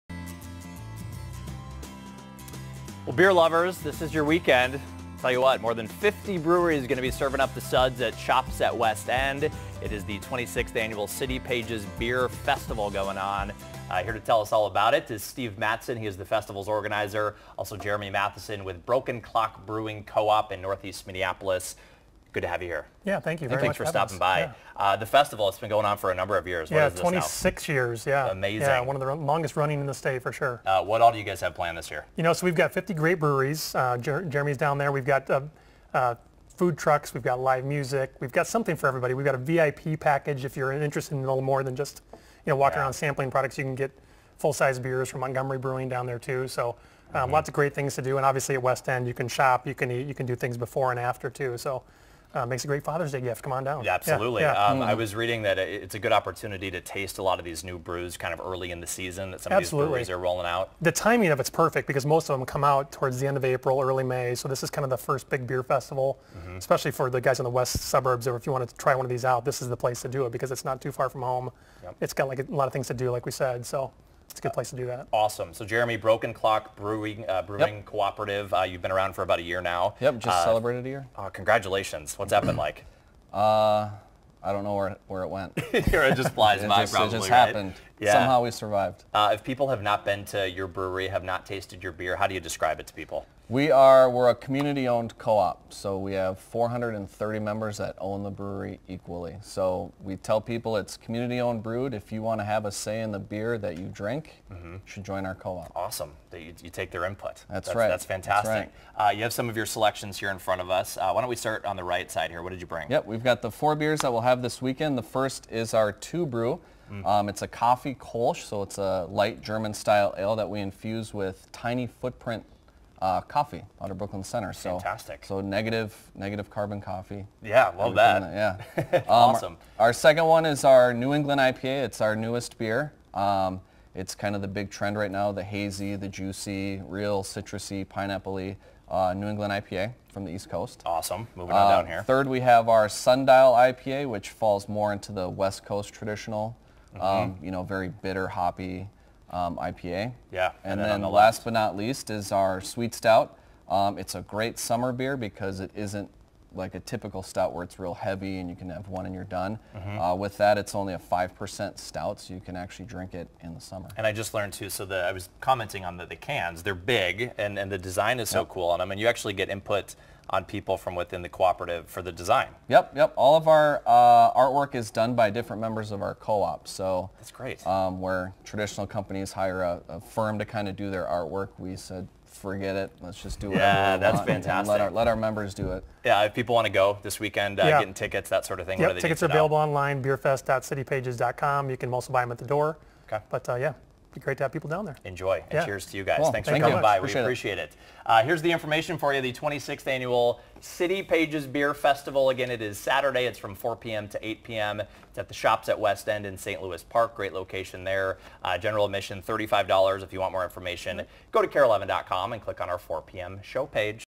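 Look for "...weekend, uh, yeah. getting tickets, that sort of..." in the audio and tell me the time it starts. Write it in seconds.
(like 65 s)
187 s.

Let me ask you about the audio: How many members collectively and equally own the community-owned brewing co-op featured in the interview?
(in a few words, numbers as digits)
430.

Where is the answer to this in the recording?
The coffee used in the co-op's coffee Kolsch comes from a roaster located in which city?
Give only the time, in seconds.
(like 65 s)
123 s.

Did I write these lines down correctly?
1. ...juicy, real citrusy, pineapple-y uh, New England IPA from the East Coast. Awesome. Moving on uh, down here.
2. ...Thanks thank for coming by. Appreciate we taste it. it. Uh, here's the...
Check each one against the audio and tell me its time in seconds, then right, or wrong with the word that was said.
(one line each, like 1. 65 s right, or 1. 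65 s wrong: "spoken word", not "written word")
1. 136 s right
2. 196 s wrong: "appreciate", not "taste".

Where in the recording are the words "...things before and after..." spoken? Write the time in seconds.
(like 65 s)
50 s.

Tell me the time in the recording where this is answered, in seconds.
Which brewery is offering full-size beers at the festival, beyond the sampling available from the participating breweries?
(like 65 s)
45 s.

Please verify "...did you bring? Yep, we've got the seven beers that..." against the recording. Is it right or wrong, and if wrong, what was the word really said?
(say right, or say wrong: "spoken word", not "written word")
wrong: "four", not "seven".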